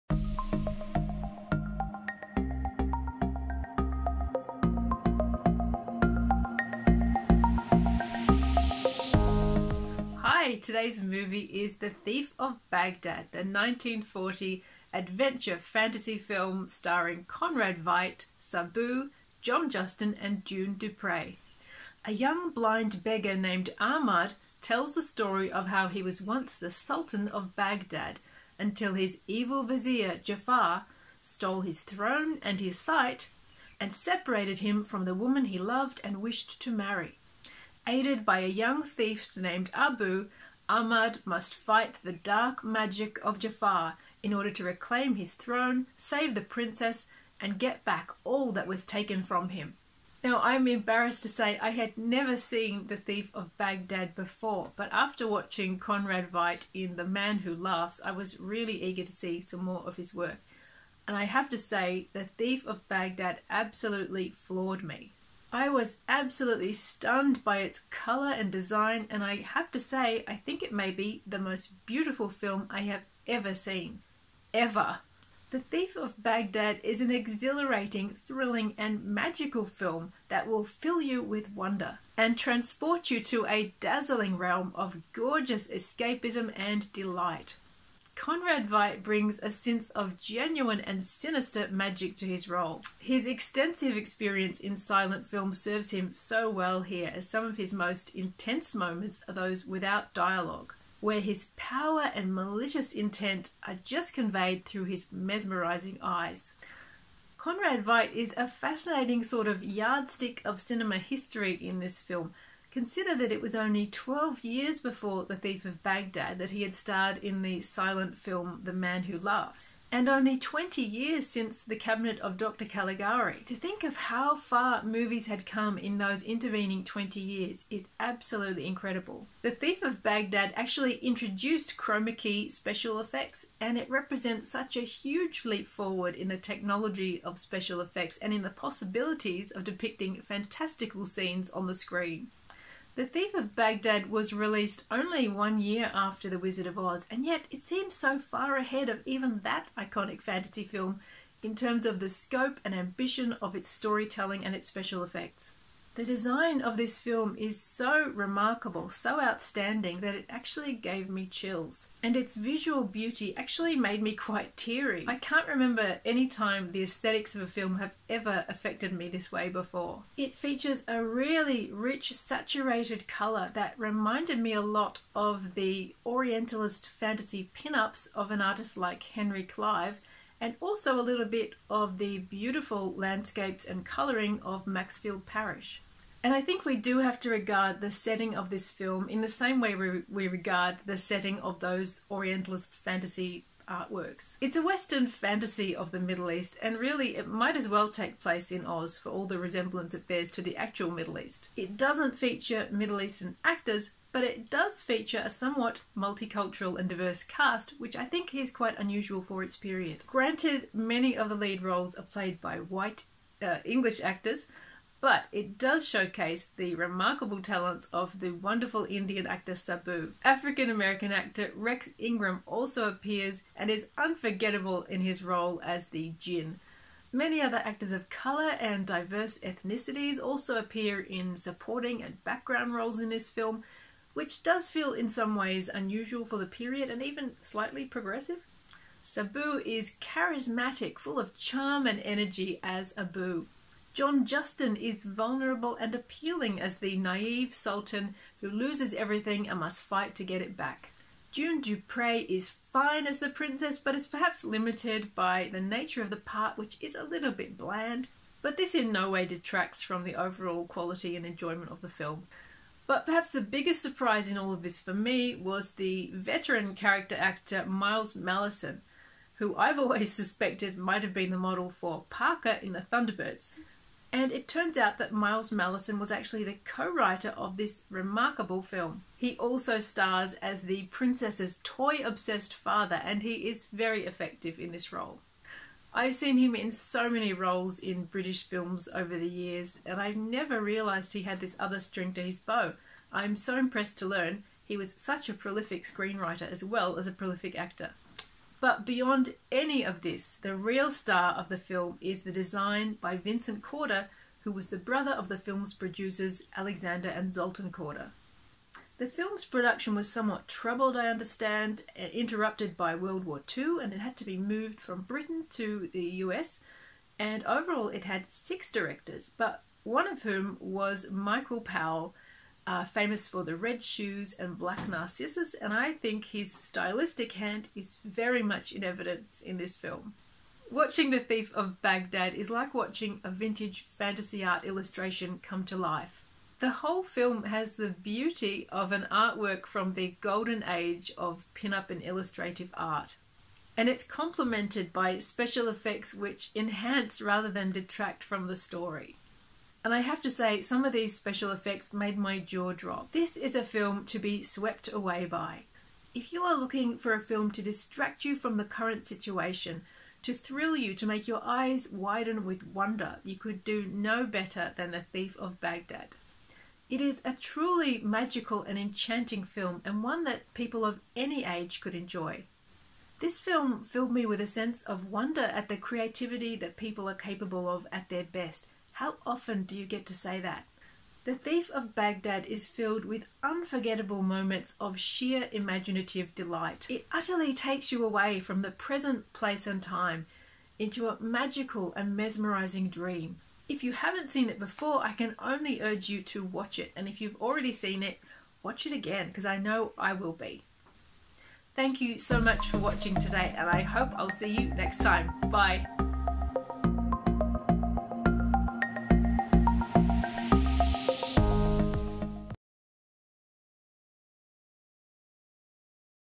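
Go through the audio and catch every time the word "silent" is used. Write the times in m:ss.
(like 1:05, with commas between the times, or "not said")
1:34, 1:57.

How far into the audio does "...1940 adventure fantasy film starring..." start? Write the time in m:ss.
0:13.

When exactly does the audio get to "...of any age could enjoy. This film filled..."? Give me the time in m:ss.
6:10.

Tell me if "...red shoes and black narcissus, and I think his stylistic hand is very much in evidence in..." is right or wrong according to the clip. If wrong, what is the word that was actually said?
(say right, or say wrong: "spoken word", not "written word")
right.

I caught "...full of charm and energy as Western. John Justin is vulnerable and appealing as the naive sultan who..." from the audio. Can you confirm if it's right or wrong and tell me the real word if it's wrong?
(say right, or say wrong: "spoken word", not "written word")
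wrong: "Abu", not "Western".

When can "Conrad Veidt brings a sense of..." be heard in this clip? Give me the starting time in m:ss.
1:28.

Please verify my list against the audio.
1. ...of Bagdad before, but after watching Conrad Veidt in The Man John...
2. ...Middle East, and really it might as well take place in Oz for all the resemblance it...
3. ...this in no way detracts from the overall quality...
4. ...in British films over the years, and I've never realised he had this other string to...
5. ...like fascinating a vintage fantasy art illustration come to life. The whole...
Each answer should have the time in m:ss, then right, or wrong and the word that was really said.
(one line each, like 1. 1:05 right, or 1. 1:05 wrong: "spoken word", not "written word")
1. 0:53 wrong: "Who", not "John"
2. 3:15 right
3. 4:18 right
4. 4:47 right
5. 5:32 wrong: "watching", not "fascinating".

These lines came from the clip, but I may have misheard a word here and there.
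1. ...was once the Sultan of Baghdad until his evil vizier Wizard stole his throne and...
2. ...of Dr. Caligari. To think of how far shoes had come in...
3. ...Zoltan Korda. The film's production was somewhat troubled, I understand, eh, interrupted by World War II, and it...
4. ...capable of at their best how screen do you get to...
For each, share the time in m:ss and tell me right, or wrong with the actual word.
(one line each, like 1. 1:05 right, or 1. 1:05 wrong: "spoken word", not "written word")
1. 0:26 wrong: "Jaffar", not "Wizard"
2. 2:02 wrong: "movies", not "shoes"
3. 5:07 right
4. 6:17 wrong: "often", not "screen".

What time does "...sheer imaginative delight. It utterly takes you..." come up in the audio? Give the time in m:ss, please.
6:24.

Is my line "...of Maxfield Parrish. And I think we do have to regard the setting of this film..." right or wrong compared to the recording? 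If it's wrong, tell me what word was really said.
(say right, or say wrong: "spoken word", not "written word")
right.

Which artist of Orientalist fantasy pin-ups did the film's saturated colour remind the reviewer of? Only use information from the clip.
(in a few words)
Henry Clive.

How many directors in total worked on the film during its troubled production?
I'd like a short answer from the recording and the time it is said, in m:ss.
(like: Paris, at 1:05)
6, at 5:18.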